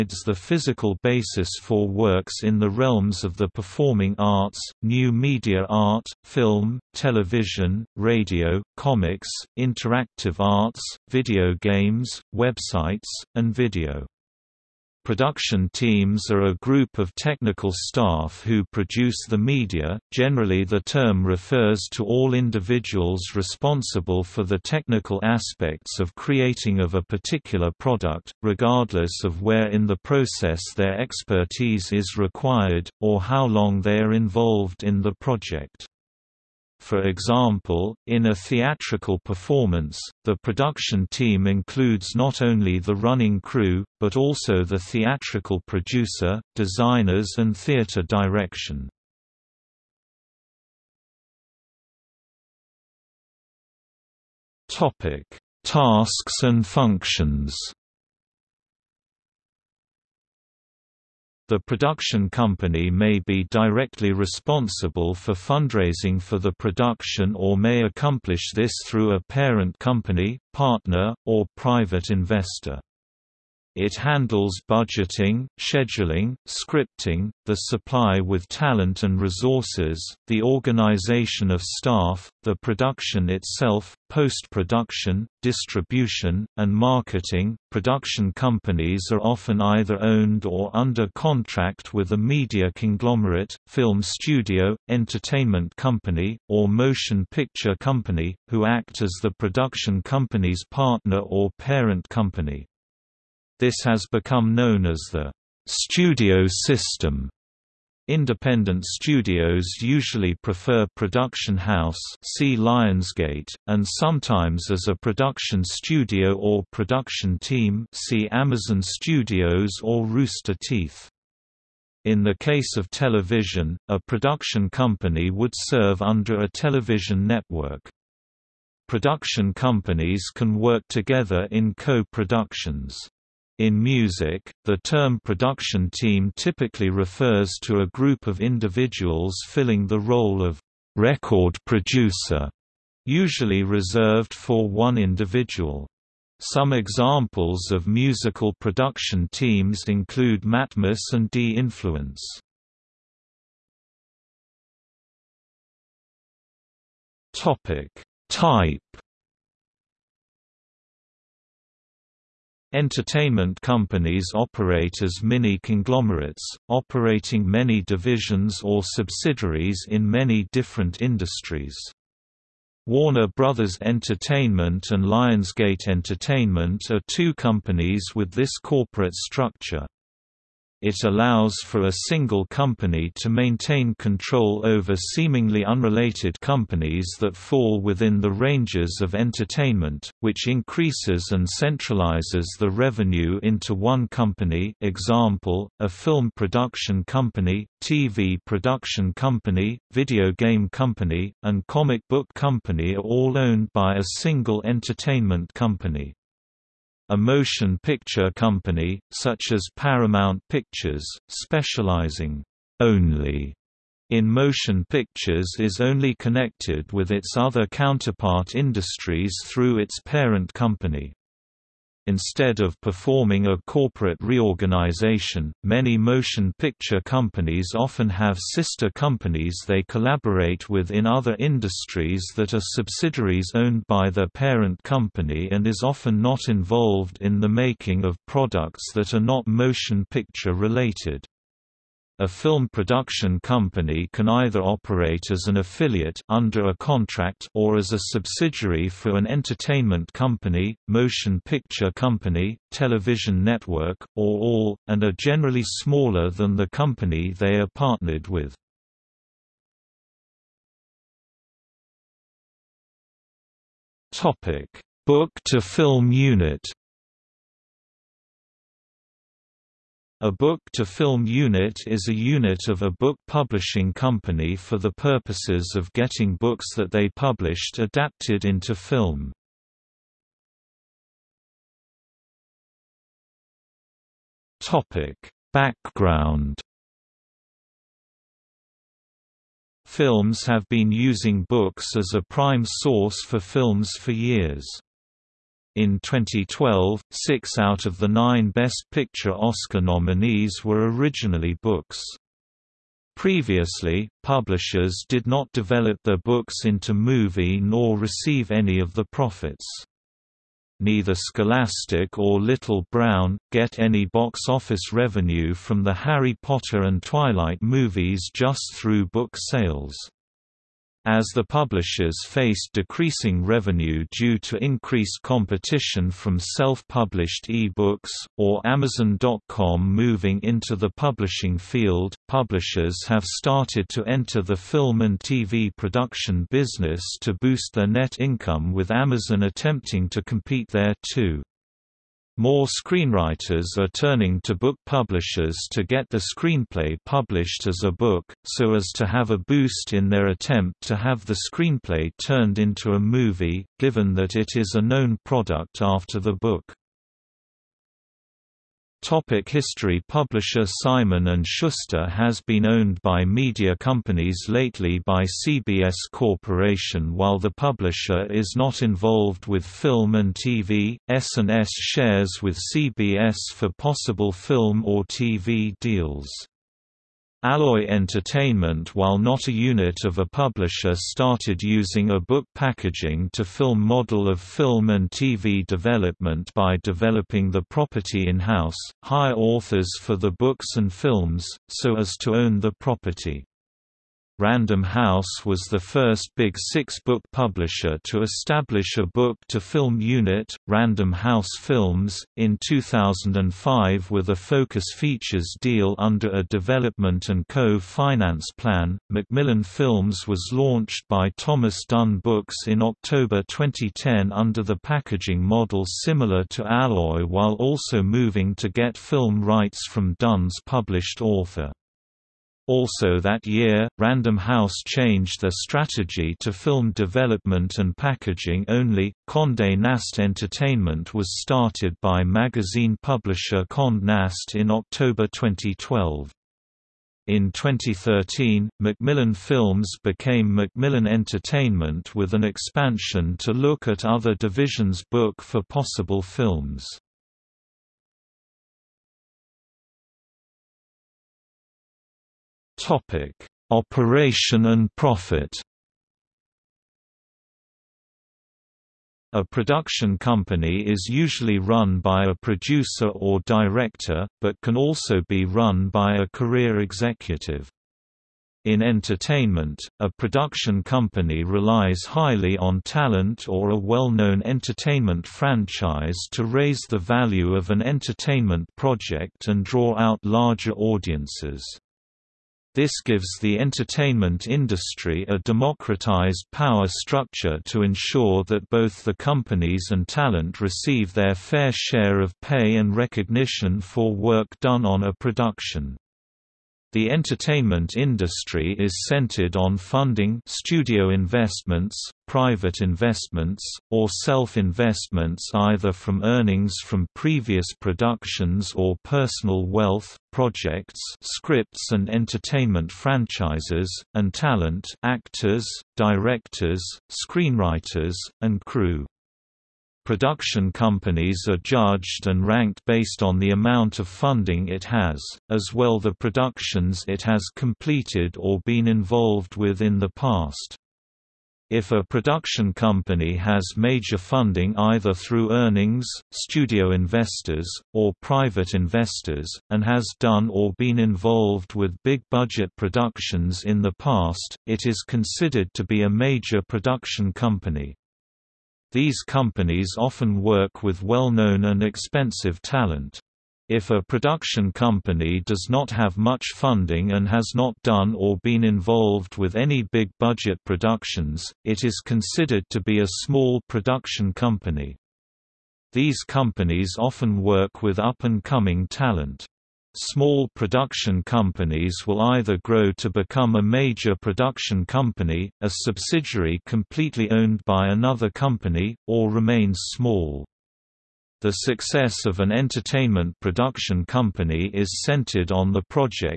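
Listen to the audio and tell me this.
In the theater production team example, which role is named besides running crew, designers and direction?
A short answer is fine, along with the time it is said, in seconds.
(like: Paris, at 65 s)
theatrical producer, at 44 s.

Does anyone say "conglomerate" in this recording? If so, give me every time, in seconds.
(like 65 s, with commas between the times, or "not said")
92 s, 165 s.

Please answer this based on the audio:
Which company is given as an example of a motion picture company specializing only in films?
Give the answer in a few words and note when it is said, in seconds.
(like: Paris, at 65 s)
Paramount Pictures, at 209 s.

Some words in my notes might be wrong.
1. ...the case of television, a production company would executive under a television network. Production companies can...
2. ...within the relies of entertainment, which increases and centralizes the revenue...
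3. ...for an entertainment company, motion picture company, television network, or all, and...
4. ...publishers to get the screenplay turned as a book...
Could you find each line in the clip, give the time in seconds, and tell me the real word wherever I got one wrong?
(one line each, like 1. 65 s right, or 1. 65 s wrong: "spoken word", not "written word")
1. 122 s wrong: "serve", not "executive"
2. 187 s wrong: "ranges", not "relies"
3. 248 s right
4. 344 s wrong: "published", not "turned".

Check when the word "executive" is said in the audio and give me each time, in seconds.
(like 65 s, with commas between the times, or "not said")
466 s.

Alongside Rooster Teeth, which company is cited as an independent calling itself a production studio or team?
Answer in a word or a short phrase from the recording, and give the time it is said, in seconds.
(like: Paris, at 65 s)
Amazon Studios, at 118 s.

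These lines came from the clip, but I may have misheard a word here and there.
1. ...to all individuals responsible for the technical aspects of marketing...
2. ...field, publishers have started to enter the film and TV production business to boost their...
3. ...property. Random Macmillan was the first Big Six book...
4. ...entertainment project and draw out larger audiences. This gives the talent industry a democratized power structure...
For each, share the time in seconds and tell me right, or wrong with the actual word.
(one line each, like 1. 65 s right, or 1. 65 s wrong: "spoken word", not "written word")
1. 21 s wrong: "creating", not "marketing"
2. 331 s right
3. 392 s wrong: "House", not "Macmillan"
4. 477 s wrong: "entertainment", not "talent".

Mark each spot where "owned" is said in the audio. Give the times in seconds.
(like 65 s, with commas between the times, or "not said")
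90 s, 203 s, 233 s, 362 s, 577 s.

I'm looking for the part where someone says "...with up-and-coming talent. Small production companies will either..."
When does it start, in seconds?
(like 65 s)
567 s.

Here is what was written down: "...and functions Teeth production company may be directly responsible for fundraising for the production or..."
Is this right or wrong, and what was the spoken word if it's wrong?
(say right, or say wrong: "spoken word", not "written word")
wrong: "The", not "Teeth".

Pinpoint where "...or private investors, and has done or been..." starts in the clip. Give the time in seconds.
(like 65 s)
537 s.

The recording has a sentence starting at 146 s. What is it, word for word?
Some examples of musical production teams include Matmos and D-Influence.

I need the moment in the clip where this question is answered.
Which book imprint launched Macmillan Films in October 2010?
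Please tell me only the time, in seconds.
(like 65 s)
411 s.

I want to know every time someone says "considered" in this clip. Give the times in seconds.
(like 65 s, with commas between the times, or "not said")
545 s, 562 s.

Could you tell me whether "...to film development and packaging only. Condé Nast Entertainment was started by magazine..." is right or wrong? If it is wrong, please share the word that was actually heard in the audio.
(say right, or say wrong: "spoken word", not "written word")
right.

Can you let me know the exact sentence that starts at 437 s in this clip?
In 2013, Macmillan Films became Macmillan Entertainment with an expansion to look at other divisions book for possible films.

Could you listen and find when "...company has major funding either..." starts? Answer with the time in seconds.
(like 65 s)
532 s.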